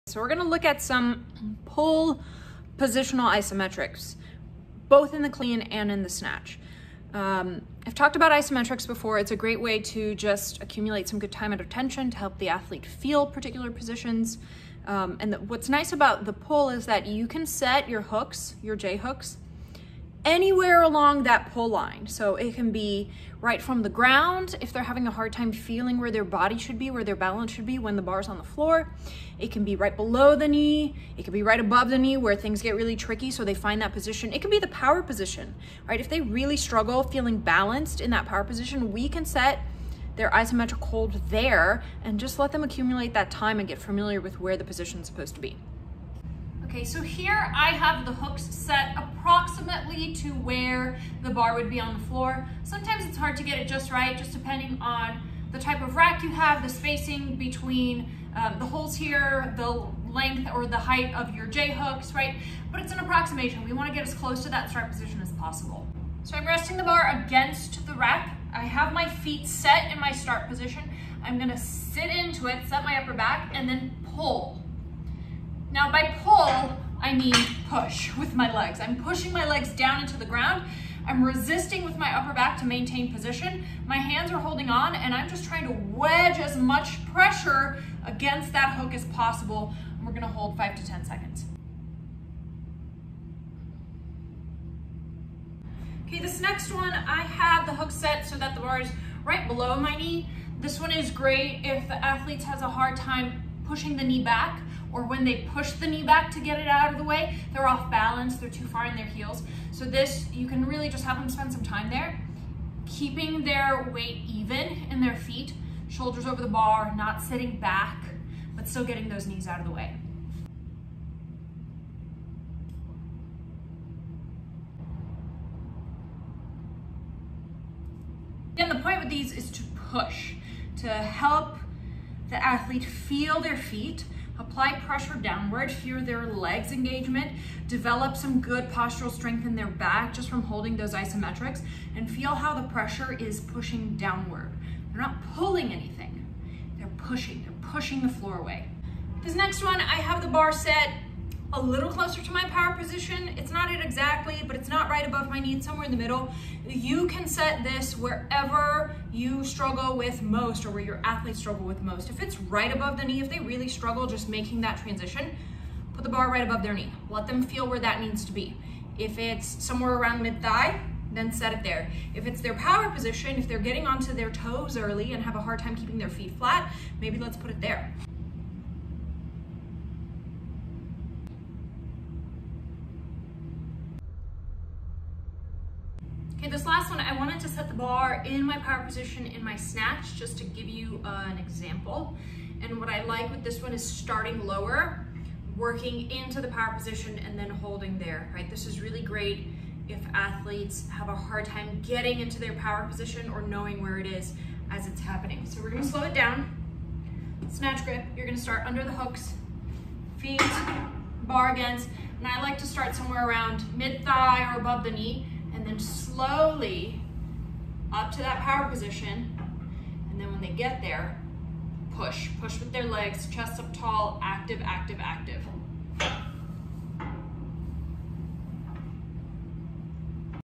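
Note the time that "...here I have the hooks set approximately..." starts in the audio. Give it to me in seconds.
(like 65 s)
47 s.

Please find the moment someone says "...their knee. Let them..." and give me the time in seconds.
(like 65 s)
166 s.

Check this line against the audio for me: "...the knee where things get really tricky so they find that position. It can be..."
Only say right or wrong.
right.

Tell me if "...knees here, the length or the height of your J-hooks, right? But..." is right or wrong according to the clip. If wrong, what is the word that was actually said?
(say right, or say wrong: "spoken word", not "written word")
wrong: "holes", not "knees".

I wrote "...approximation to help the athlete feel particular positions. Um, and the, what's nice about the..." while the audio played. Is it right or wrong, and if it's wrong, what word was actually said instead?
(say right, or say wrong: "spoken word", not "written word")
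wrong: "tension", not "approximation".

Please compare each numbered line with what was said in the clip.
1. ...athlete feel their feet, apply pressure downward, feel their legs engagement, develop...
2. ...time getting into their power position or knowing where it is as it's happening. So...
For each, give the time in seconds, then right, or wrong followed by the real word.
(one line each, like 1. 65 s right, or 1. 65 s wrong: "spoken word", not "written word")
1. 132 s right
2. 201 s right.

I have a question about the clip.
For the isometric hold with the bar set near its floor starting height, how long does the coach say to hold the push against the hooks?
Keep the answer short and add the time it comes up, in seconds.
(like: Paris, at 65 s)
5 to 10 seconds, at 90 s.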